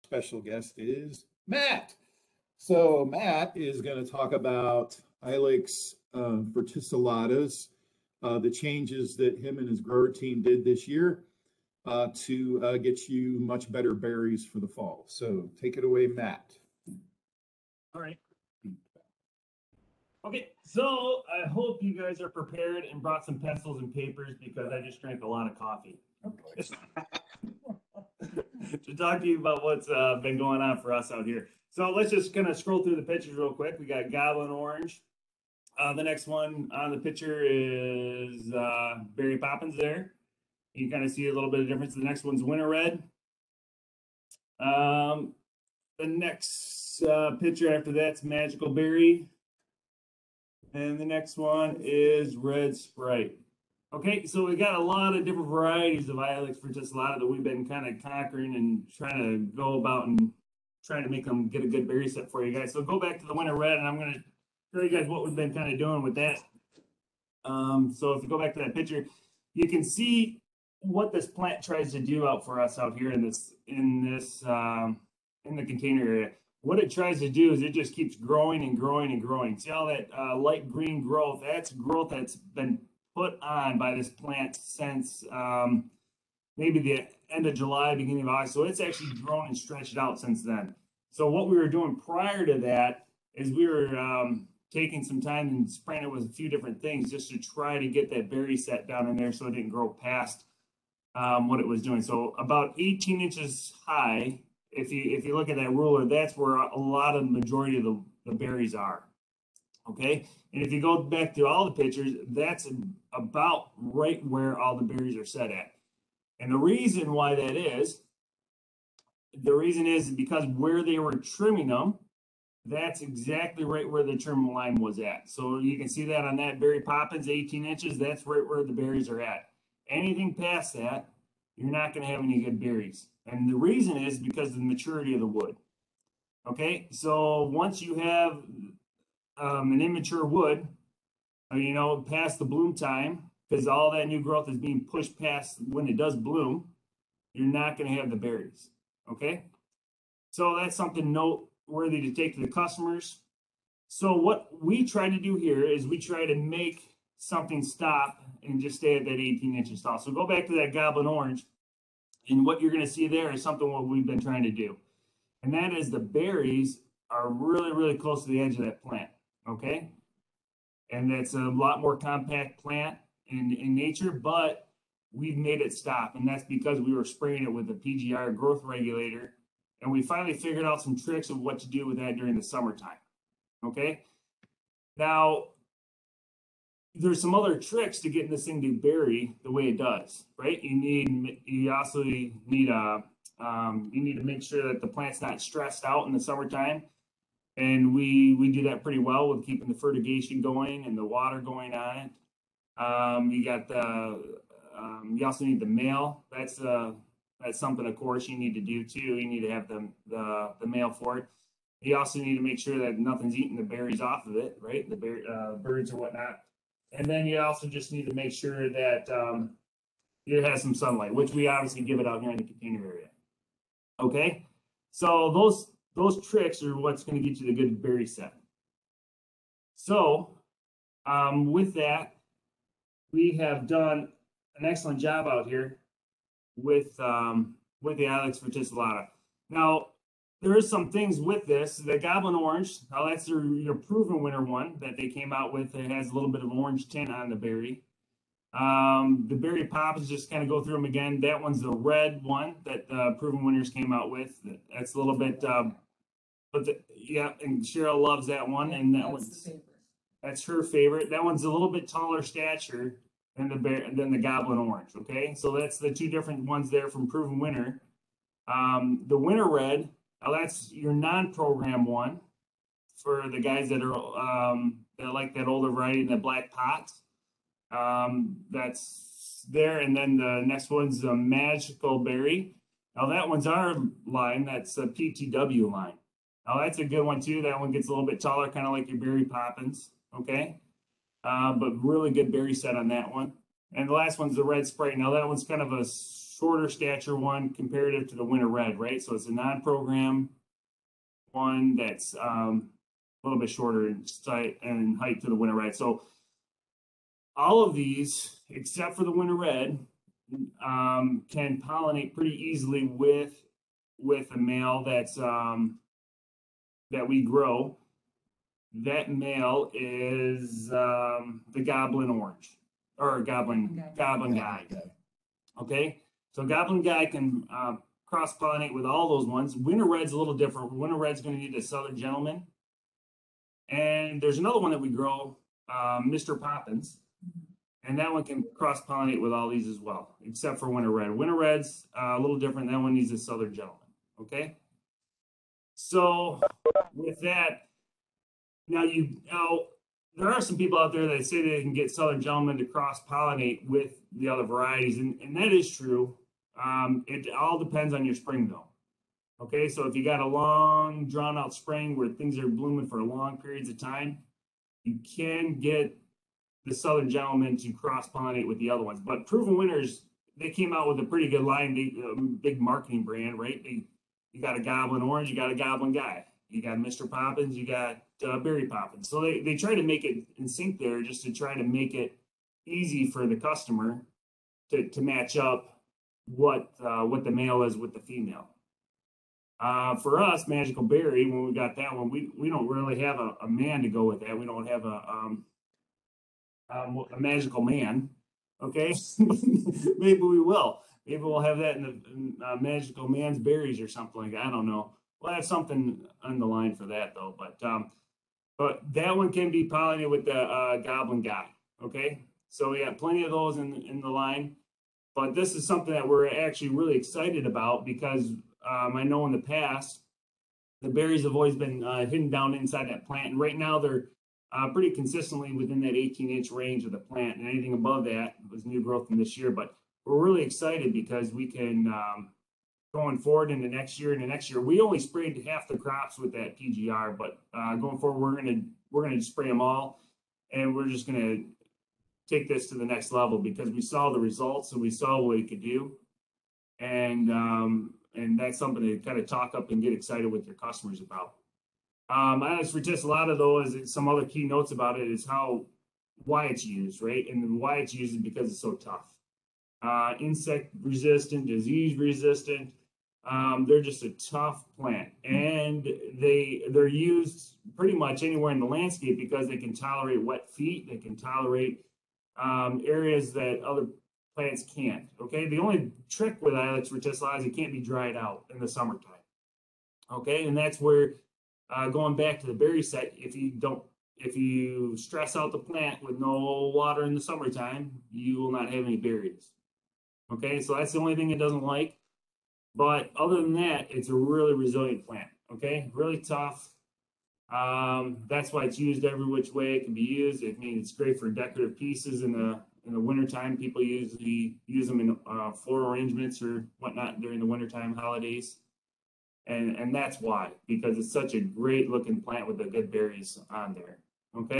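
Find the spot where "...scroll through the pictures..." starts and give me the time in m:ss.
0:32.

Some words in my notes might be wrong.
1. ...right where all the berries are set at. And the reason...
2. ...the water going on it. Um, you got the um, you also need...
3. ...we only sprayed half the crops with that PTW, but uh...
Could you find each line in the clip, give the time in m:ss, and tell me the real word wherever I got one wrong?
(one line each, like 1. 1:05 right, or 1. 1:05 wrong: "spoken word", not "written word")
1. 1:53 right
2. 3:20 right
3. 7:14 wrong: "PGR", not "PTW".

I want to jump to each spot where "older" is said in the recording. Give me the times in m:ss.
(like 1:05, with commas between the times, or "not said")
4:35.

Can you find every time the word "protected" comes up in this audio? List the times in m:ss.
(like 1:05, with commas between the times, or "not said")
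not said.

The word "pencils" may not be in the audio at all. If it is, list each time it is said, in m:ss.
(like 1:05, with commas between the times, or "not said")
0:23.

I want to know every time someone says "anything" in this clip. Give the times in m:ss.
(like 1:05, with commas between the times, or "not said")
2:09, 7:07.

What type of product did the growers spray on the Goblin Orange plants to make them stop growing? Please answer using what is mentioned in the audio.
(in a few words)
PGR growth regulator.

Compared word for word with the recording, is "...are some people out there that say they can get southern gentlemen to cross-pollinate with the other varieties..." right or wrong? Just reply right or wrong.
right.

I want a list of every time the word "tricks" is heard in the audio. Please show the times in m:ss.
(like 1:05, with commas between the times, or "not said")
3:00, 3:07, 3:46, 7:56.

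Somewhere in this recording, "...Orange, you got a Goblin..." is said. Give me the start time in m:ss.
6:15.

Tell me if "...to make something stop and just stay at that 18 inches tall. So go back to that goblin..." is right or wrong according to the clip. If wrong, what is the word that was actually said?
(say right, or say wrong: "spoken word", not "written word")
right.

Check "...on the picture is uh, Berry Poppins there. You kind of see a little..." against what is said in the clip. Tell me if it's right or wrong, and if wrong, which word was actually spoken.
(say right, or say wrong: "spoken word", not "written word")
right.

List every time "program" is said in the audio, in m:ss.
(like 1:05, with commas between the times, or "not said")
4:30, 4:59.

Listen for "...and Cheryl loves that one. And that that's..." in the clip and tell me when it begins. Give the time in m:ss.
4:17.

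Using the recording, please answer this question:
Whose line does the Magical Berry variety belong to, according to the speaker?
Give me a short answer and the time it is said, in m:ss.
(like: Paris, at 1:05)
PTW, at 4:44.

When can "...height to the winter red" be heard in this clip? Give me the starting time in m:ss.
5:04.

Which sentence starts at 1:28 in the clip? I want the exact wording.
So it's actually grown and stretched out since then.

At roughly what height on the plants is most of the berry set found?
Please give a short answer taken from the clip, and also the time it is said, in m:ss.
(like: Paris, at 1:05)
18 inches, at 1:42.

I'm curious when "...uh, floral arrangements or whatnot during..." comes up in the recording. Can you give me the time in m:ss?
8:25.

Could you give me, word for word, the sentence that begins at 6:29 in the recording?
Uh, for us, Magical Berry, when we got that one, we, we don't really have a, a man to go with that.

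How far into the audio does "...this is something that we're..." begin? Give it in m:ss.
6:55.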